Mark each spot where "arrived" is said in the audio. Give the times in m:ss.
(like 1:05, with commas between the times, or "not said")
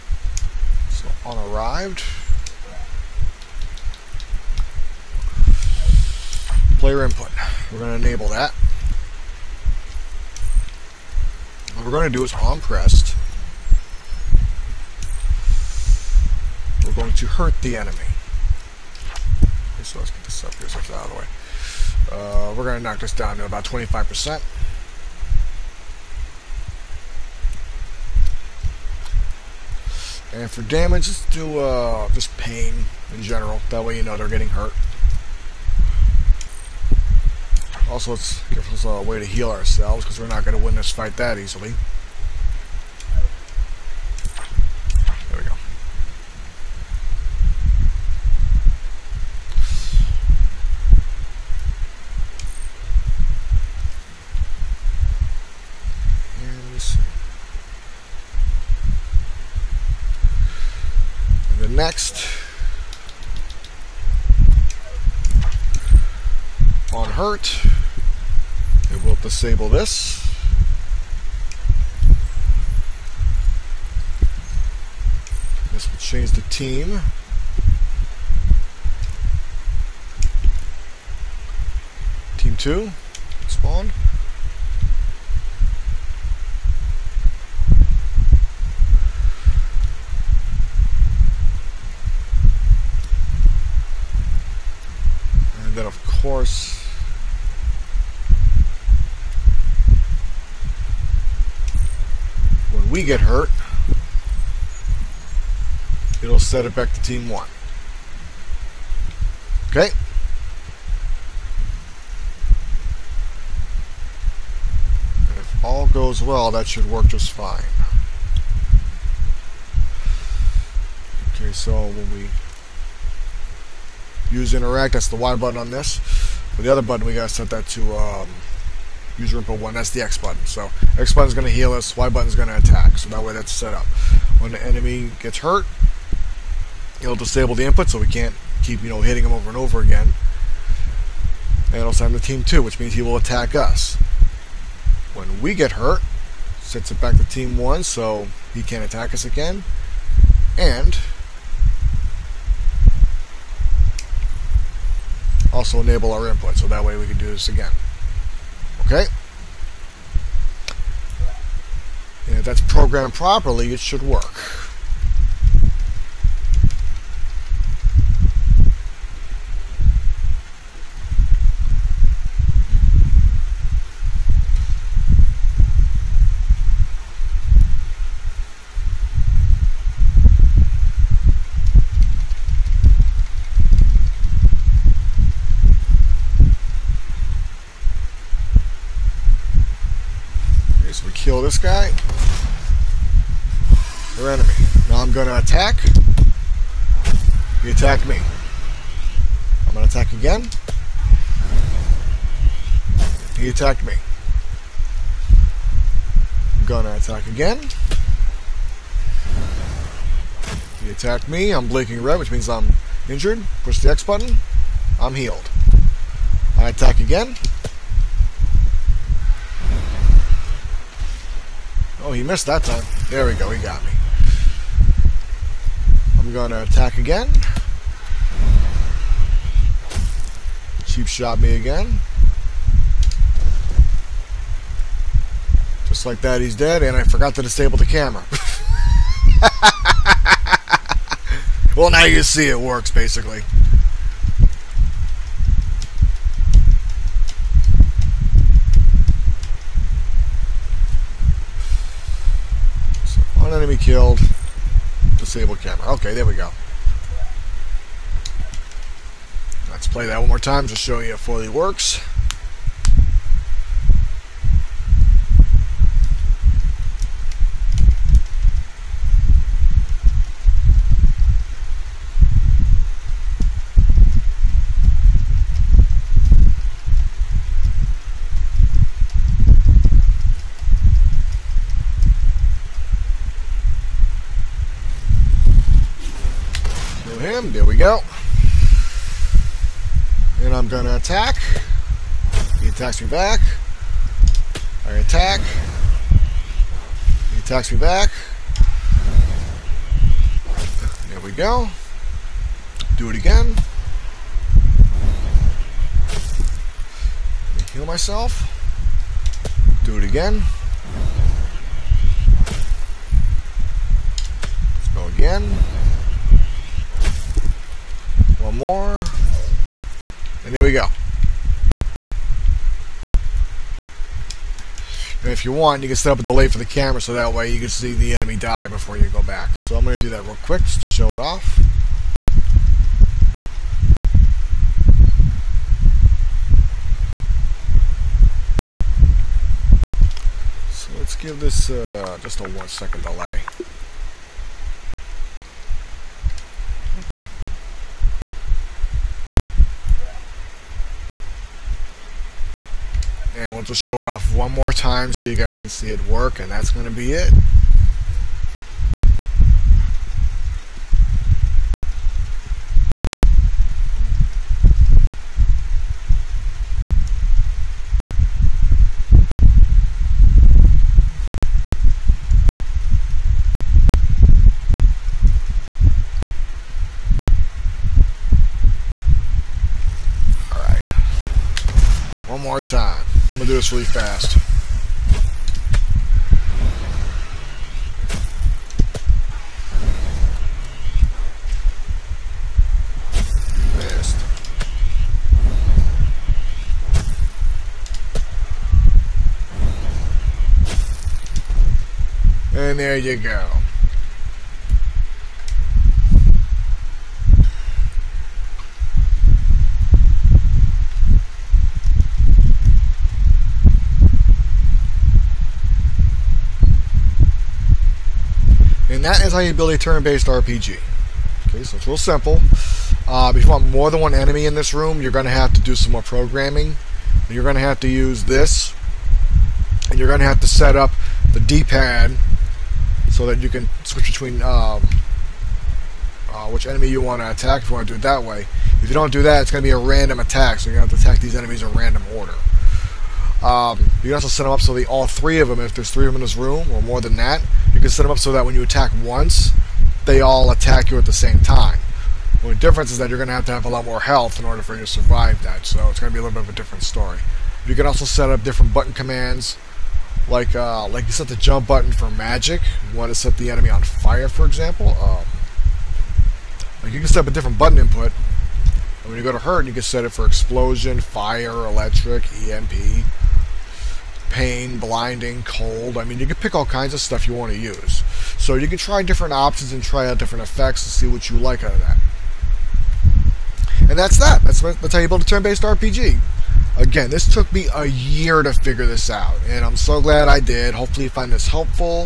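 0:01.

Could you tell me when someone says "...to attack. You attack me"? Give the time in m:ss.
3:15.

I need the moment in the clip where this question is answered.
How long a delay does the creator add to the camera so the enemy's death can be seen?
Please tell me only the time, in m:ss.
5:42.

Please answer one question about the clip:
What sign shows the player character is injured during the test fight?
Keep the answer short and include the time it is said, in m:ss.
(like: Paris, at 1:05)
Blinking red, at 3:31.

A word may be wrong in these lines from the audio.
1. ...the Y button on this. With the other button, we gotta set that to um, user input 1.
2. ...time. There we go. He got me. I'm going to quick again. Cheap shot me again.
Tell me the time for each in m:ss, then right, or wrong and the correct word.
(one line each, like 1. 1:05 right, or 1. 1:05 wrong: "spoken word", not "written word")
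1. 2:05 right
2. 3:42 wrong: "attack", not "quick".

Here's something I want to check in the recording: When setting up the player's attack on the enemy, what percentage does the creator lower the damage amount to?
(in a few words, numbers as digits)
25%.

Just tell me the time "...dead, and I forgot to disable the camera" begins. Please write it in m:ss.
3:56.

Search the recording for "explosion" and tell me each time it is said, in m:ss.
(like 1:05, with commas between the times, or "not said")
7:50.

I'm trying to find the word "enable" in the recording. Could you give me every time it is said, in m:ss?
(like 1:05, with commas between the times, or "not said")
0:08, 2:35.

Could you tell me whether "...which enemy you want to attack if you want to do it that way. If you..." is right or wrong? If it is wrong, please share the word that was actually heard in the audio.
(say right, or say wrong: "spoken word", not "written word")
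right.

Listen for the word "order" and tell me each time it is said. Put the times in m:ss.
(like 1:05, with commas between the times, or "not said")
7:22, 7:34.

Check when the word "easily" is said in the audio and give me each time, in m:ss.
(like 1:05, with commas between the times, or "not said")
0:41.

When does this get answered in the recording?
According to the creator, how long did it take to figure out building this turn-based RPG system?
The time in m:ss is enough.
8:07.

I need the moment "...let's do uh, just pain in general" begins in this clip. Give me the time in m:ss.
0:31.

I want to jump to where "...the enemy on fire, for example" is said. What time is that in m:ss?
7:43.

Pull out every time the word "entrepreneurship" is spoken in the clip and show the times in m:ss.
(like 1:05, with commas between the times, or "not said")
not said.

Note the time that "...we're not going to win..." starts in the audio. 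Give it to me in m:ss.
0:40.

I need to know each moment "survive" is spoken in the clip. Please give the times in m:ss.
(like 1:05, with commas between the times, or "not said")
7:34.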